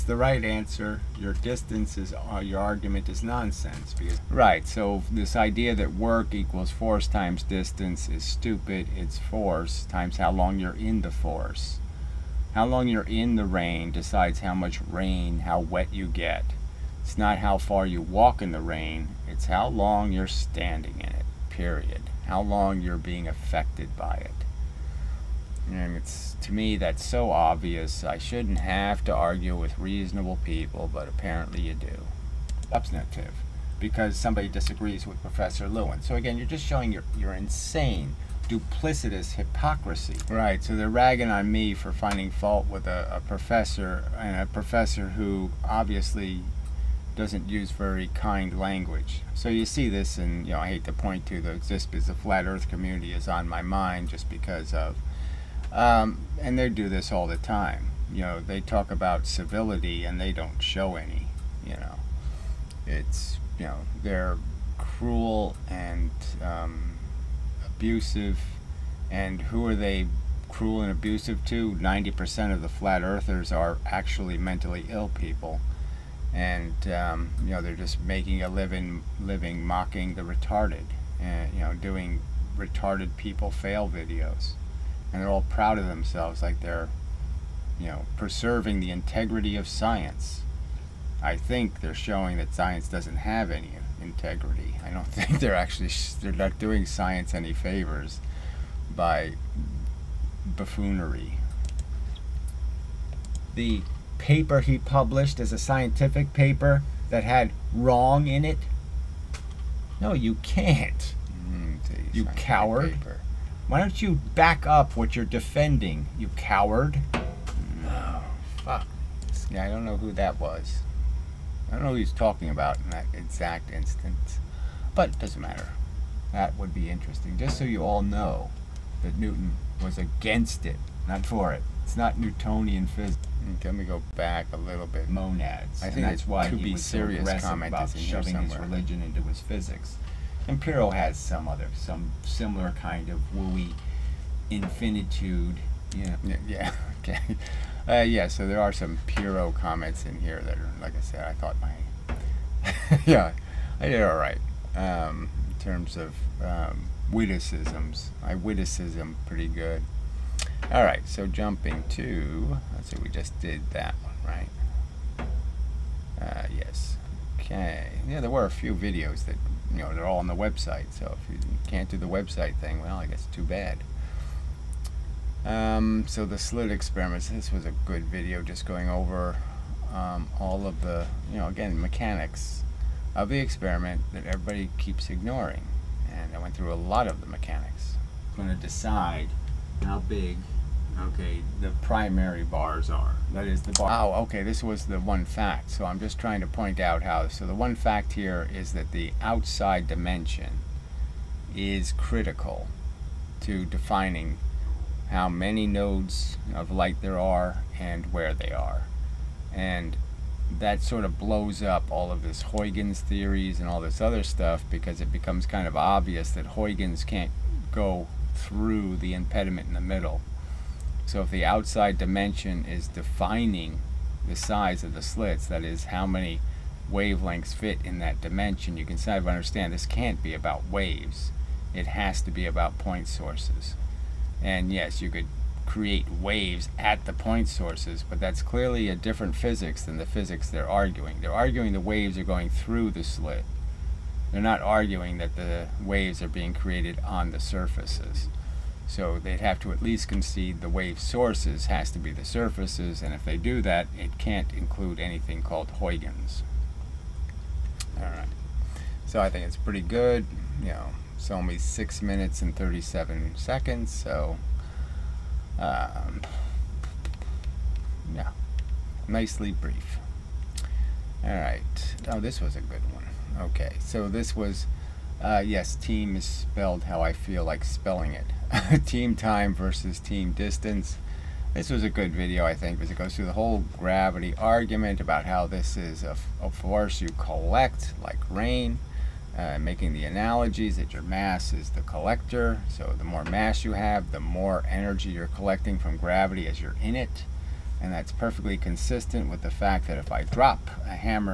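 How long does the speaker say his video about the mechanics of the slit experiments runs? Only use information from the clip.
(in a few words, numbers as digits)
6 minutes and 37 seconds.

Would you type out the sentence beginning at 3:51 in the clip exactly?
It has to be about point sources.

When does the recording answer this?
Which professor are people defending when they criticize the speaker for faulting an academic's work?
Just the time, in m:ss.
0:35.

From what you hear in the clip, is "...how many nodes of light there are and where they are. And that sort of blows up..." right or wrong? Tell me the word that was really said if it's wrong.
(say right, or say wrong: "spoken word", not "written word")
right.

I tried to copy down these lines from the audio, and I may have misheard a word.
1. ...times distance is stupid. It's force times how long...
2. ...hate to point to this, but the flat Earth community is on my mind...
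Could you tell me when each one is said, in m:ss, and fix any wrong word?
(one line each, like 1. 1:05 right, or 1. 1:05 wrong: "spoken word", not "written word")
1. 0:07 right
2. 0:50 right.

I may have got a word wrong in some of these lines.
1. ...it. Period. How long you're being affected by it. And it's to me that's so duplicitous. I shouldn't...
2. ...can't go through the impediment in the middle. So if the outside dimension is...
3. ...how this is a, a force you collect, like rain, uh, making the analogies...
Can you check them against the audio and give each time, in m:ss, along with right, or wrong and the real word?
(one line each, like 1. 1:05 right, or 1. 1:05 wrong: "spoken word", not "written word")
1. 0:21 wrong: "obvious", not "duplicitous"
2. 3:37 right
3. 4:45 right.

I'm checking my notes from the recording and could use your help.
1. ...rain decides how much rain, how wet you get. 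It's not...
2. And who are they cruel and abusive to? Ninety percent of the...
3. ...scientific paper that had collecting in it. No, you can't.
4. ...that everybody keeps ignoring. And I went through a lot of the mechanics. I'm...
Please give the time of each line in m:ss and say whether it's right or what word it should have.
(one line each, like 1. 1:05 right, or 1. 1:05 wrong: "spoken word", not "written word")
1. 0:13 right
2. 1:09 right
3. 1:45 wrong: "wrong", not "collecting"
4. 3:04 right.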